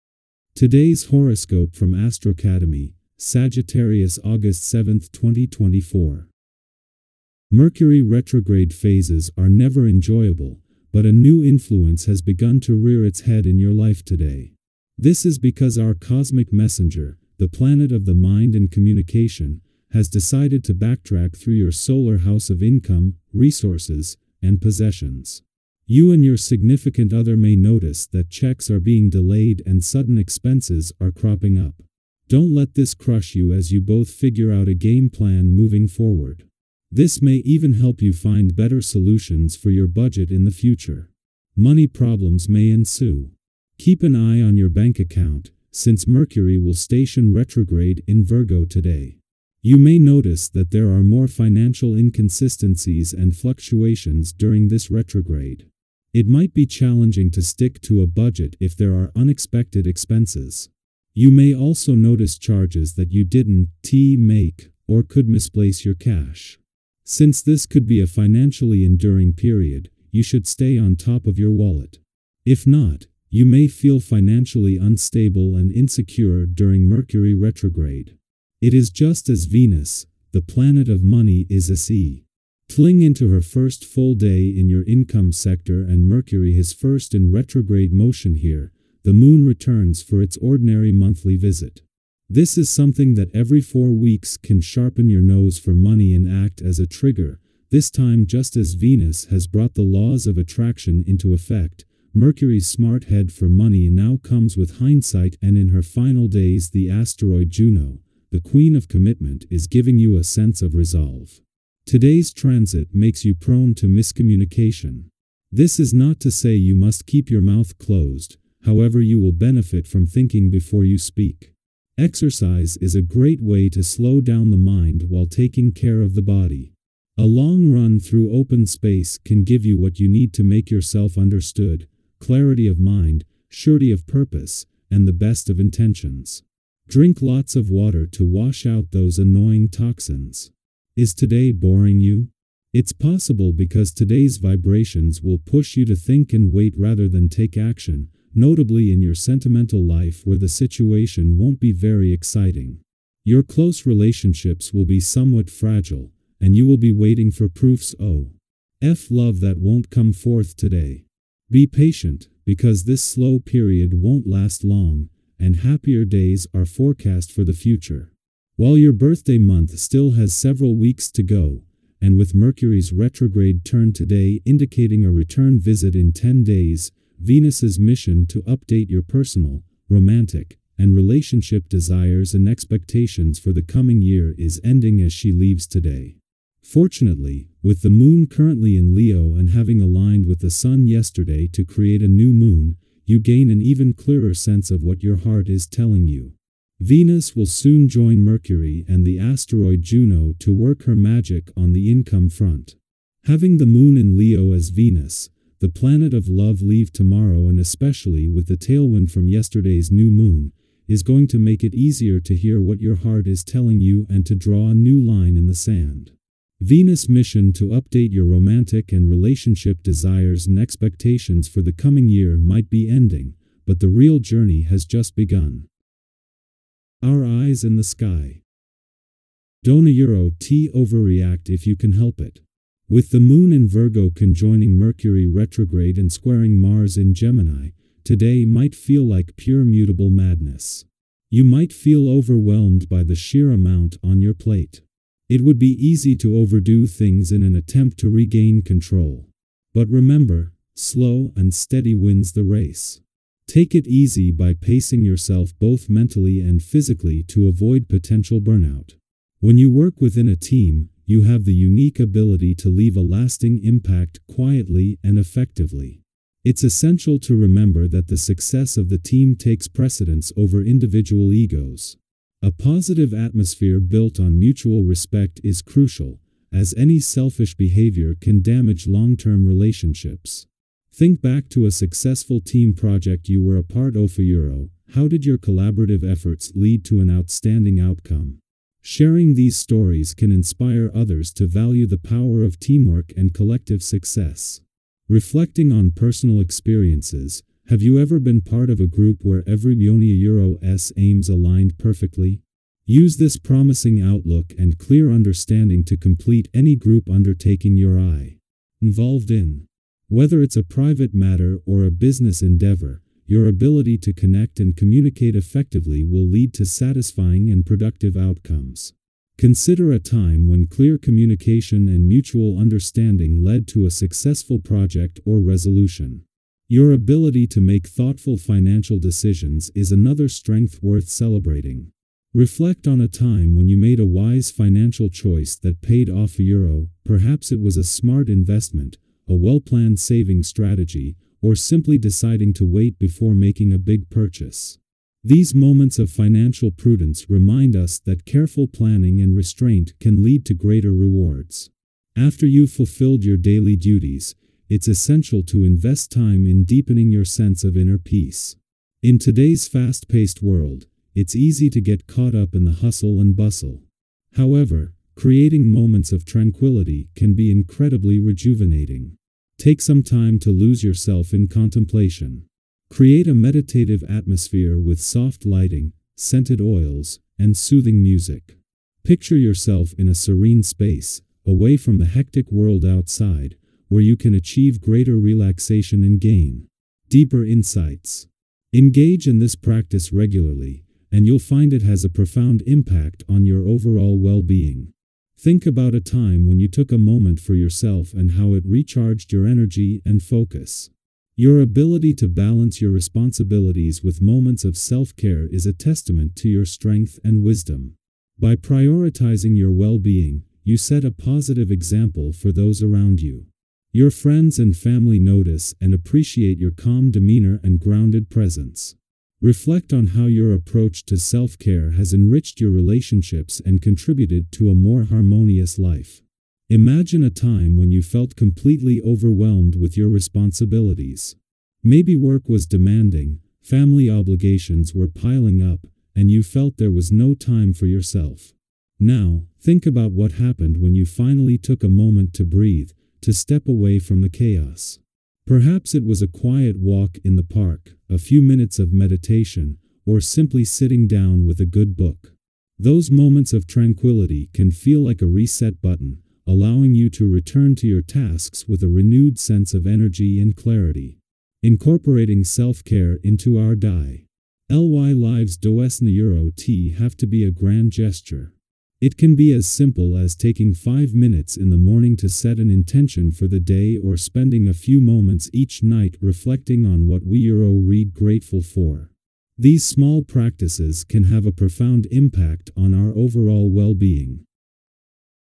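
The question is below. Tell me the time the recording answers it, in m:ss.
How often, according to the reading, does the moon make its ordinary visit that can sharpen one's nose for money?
1:33.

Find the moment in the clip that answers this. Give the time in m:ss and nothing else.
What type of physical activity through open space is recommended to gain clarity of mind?
2:07.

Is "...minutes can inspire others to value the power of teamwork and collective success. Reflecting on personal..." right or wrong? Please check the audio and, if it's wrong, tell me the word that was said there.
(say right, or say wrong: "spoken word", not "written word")
wrong: "stories", not "minutes".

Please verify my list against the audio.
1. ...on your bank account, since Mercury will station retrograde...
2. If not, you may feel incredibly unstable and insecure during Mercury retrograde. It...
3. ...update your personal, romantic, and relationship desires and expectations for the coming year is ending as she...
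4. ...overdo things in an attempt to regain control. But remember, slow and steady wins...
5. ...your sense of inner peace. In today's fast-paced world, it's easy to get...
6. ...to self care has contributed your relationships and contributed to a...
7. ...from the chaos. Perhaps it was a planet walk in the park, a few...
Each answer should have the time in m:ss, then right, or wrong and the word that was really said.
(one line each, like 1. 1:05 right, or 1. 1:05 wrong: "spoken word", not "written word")
1. 0:44 right
2. 1:12 wrong: "financially", not "incredibly"
3. 2:58 right
4. 4:06 right
5. 5:57 right
6. 7:01 wrong: "enriched", not "contributed"
7. 7:23 wrong: "quiet", not "planet".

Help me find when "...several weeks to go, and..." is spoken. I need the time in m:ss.
2:50.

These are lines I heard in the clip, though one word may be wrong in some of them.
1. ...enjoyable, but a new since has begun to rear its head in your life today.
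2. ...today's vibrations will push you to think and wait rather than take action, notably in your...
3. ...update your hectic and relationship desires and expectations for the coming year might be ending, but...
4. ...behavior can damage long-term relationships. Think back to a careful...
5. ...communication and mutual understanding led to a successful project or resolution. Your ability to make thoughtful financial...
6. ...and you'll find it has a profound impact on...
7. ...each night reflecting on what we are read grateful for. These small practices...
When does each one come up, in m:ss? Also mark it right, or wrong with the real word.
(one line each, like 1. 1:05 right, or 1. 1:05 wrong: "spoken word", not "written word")
1. 0:09 wrong: "influence", not "since"
2. 2:23 right
3. 3:37 wrong: "romantic", not "hectic"
4. 4:37 wrong: "successful", not "careful"
5. 5:20 right
6. 6:31 right
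7. 7:55 right.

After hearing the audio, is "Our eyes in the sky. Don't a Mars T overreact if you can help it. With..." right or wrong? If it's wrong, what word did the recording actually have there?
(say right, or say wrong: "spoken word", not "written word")
wrong: "Euro", not "Mars".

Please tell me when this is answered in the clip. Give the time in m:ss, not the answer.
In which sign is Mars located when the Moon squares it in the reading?
3:56.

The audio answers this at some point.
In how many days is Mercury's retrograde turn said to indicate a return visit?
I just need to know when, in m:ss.
2:55.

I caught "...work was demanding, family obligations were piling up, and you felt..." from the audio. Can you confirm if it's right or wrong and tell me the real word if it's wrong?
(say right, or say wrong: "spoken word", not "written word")
right.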